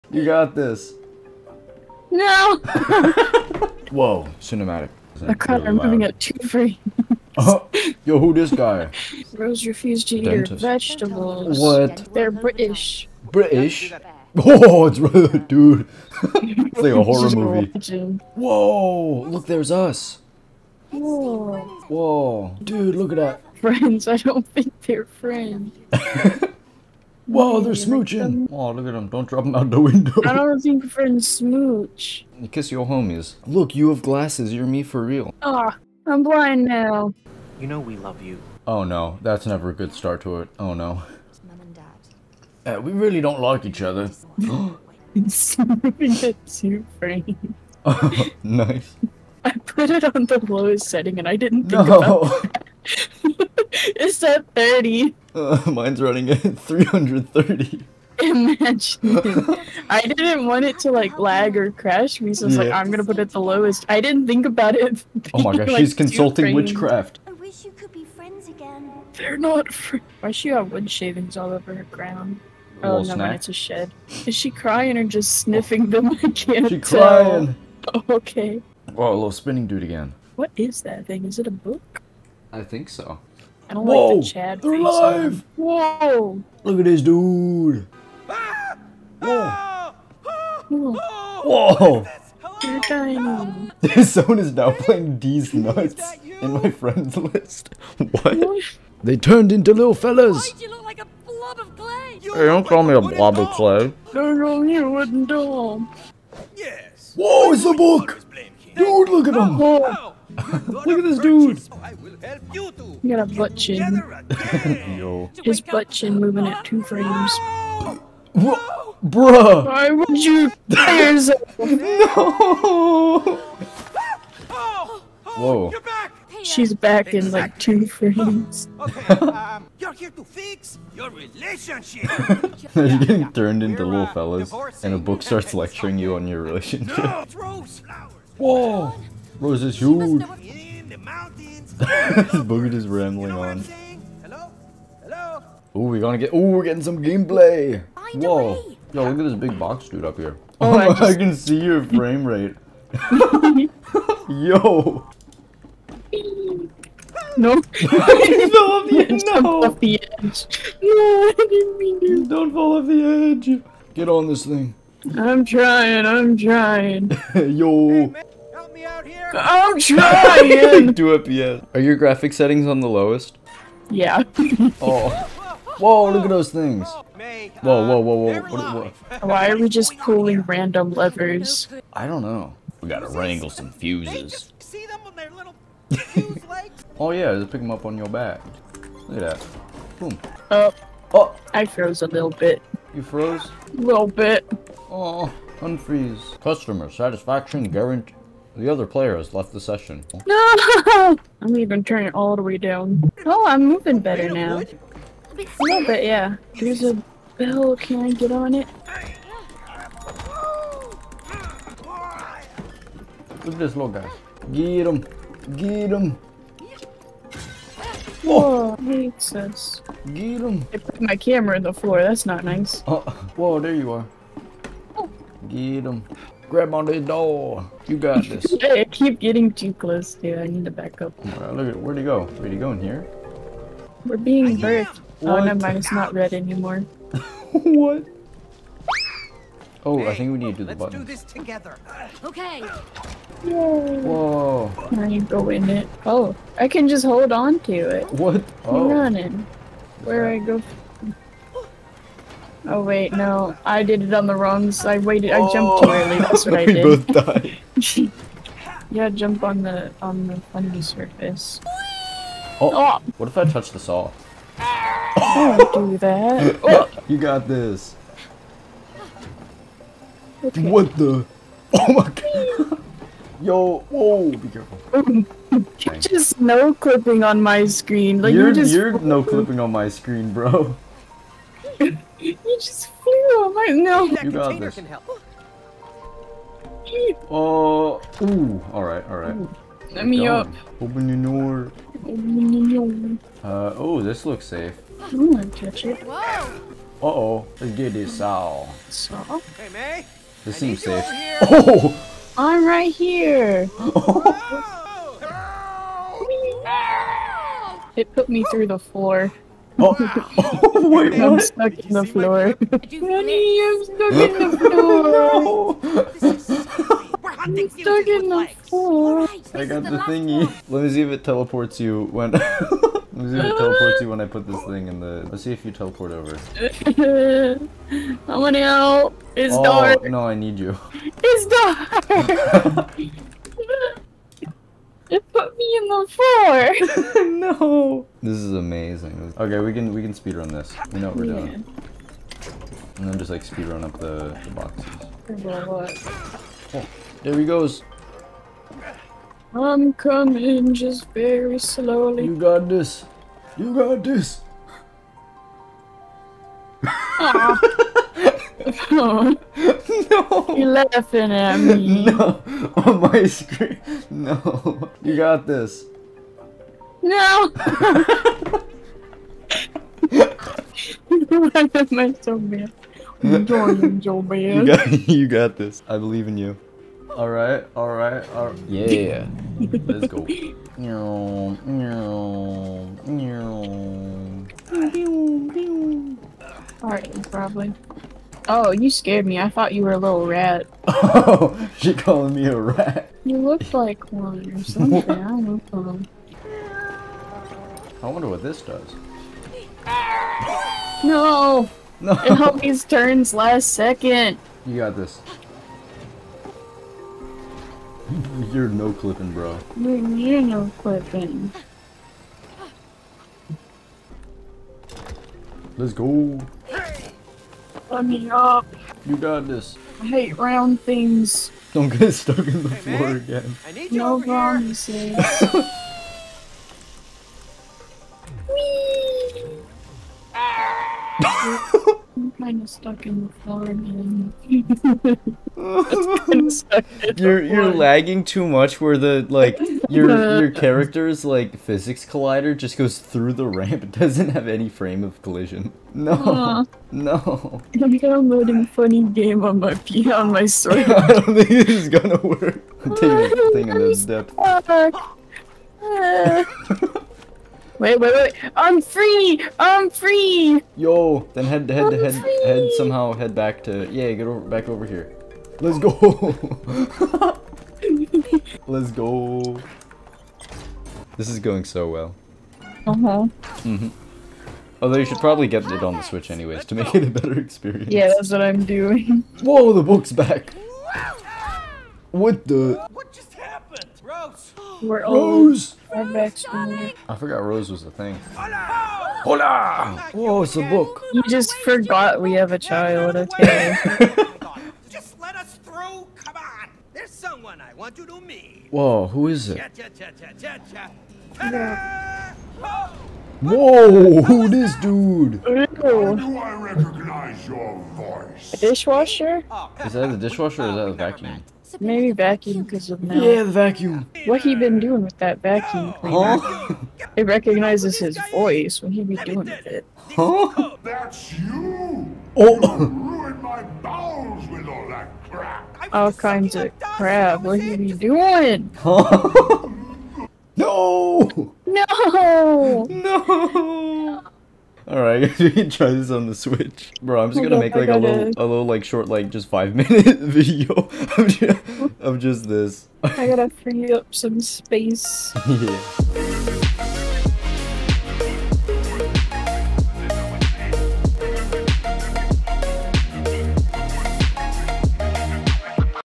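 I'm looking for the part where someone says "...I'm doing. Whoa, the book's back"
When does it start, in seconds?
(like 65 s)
478 s.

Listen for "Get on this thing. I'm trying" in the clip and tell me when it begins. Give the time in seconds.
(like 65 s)
163 s.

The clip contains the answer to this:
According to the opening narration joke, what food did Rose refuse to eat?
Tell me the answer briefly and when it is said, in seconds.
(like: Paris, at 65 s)
vegetables, at 10 s.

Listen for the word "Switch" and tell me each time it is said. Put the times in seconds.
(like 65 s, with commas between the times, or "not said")
476 s, 536 s.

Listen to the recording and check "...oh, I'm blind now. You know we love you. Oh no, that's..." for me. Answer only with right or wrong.
right.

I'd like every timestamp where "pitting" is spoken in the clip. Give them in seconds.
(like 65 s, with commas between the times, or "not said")
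not said.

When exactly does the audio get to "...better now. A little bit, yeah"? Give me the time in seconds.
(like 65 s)
203 s.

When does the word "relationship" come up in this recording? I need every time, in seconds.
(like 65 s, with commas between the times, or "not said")
131 s, 136 s.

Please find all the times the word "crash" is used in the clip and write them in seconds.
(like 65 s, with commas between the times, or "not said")
61 s.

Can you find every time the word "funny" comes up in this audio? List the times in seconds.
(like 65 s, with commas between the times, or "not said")
260 s, 448 s.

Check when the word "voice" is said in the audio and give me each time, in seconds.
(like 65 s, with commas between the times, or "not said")
507 s, 518 s.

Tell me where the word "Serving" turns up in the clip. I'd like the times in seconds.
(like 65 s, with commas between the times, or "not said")
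45 s.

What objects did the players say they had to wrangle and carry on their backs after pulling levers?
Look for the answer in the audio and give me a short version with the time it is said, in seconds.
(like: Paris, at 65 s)
fuses, at 183 s.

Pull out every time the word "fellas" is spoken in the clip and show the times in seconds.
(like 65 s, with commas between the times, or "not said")
99 s, 134 s.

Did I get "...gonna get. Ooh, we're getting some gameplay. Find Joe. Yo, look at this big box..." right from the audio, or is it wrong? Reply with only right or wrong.
wrong.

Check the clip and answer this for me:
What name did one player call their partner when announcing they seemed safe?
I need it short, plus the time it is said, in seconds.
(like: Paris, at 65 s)
May, at 299 s.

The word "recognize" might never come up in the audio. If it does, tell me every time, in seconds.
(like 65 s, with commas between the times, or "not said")
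506 s, 517 s.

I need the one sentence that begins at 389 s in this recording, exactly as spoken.
I thought you were a little rat.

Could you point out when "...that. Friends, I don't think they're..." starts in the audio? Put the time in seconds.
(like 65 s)
23 s.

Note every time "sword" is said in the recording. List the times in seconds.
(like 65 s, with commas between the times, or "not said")
450 s.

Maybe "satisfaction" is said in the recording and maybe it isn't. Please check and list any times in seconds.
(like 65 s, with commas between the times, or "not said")
196 s.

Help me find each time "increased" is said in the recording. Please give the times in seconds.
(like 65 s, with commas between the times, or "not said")
not said.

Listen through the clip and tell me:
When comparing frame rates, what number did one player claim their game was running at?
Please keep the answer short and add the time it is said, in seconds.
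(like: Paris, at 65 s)
330, at 56 s.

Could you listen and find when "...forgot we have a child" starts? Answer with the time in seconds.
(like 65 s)
491 s.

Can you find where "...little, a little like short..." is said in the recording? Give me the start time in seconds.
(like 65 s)
537 s.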